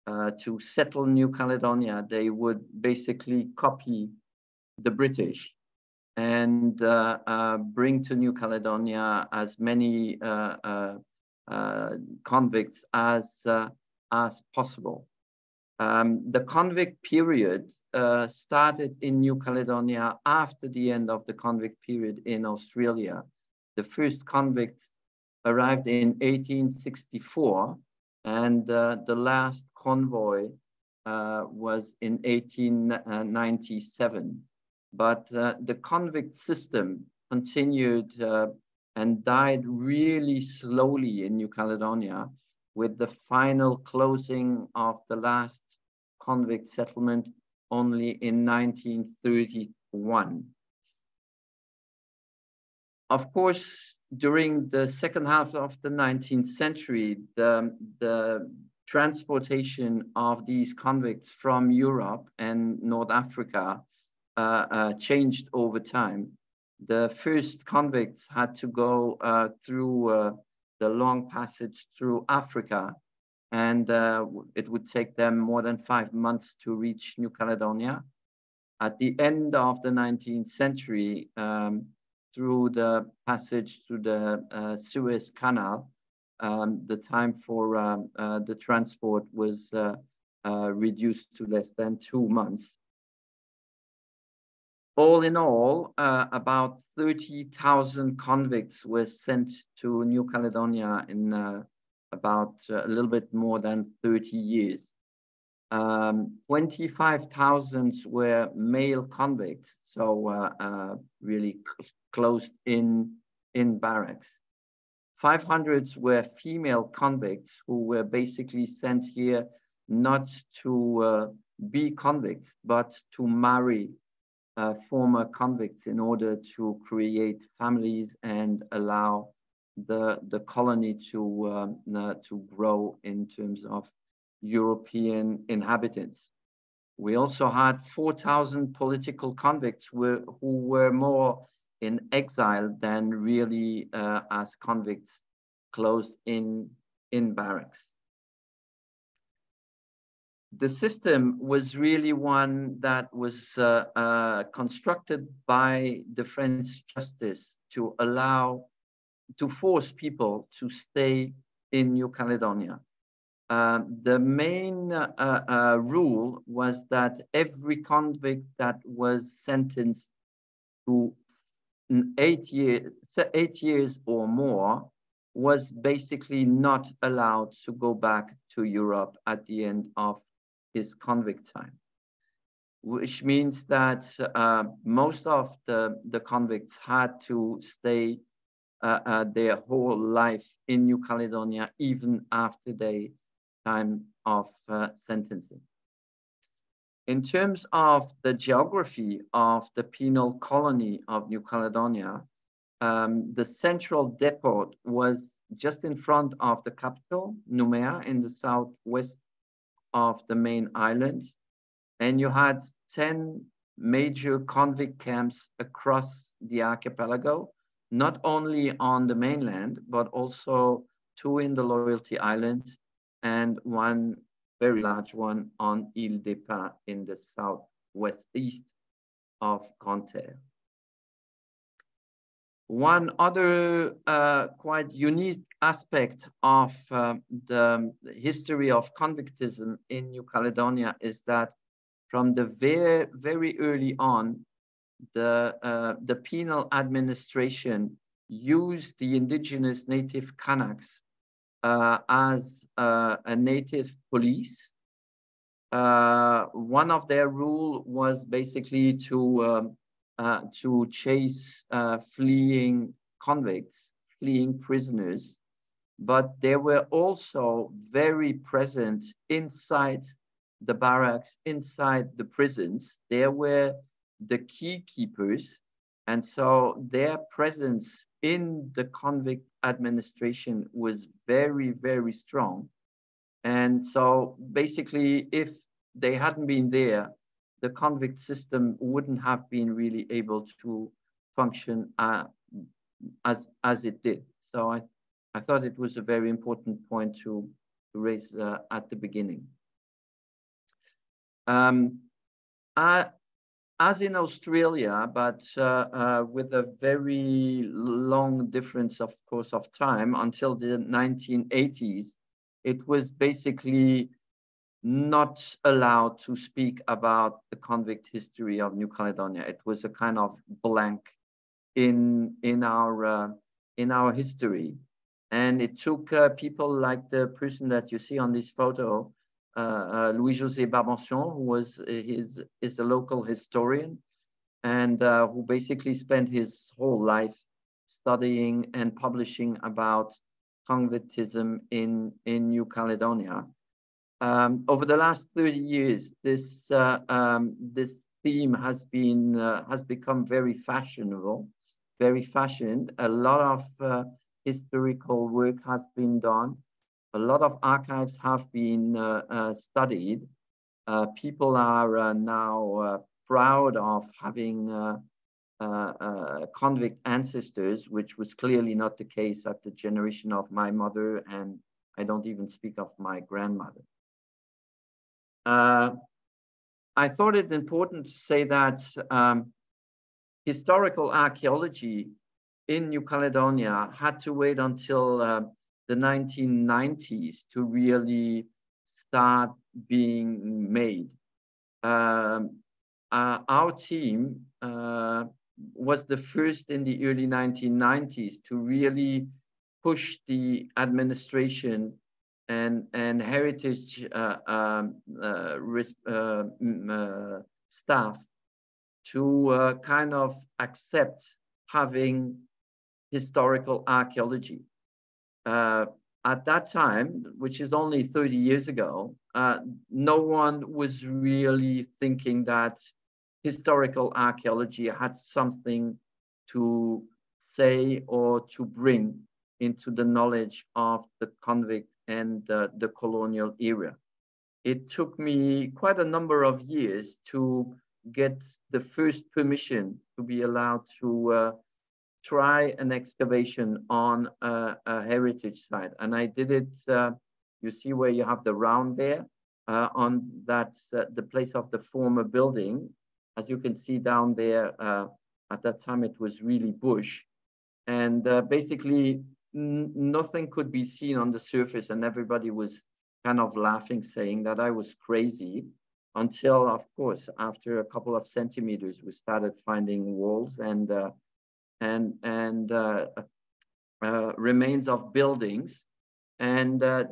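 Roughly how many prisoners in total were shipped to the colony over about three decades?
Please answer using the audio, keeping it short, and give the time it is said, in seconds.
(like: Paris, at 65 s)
30,000, at 96 s.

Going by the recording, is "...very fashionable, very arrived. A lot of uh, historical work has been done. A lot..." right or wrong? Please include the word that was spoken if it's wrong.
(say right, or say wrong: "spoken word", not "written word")
wrong: "fashioned", not "arrived".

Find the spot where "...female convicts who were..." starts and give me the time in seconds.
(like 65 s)
116 s.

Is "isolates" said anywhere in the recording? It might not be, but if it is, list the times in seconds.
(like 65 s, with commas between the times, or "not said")
not said.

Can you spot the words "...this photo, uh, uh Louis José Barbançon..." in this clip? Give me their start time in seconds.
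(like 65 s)
328 s.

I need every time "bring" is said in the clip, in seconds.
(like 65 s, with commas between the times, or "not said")
7 s, 428 s.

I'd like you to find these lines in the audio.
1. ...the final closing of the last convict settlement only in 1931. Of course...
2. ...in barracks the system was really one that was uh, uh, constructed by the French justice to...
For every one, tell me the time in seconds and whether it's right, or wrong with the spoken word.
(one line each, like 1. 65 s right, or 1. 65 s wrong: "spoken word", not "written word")
1. 42 s right
2. 147 s right.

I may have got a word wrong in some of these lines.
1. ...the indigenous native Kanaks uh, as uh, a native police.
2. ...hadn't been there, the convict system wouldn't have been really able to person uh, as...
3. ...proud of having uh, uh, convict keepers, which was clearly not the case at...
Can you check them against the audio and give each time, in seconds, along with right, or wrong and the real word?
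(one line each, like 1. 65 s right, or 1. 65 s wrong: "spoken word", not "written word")
1. 248 s right
2. 286 s wrong: "function", not "person"
3. 363 s wrong: "ancestors", not "keepers".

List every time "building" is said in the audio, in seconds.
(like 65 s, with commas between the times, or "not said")
452 s, 475 s.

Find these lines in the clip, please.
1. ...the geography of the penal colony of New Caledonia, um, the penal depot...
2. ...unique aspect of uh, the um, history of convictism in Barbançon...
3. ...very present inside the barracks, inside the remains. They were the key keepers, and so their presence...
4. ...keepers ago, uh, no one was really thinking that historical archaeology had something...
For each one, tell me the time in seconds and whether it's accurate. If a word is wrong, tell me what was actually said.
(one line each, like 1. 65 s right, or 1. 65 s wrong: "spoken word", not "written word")
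1. 198 s wrong: "central", not "penal"
2. 234 s wrong: "New", not "Barbançon"
3. 267 s wrong: "prisons", not "remains"
4. 418 s wrong: "years", not "keepers".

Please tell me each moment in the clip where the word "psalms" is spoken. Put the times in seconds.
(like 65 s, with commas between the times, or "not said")
not said.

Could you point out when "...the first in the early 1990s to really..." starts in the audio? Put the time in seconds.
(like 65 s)
396 s.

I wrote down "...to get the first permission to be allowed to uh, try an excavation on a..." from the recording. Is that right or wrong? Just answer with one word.
right.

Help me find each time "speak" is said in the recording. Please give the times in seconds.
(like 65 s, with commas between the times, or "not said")
316 s, 372 s.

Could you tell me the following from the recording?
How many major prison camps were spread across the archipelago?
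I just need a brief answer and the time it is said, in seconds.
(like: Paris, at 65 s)
10, at 212 s.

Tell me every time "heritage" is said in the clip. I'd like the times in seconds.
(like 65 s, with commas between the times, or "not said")
403 s, 445 s.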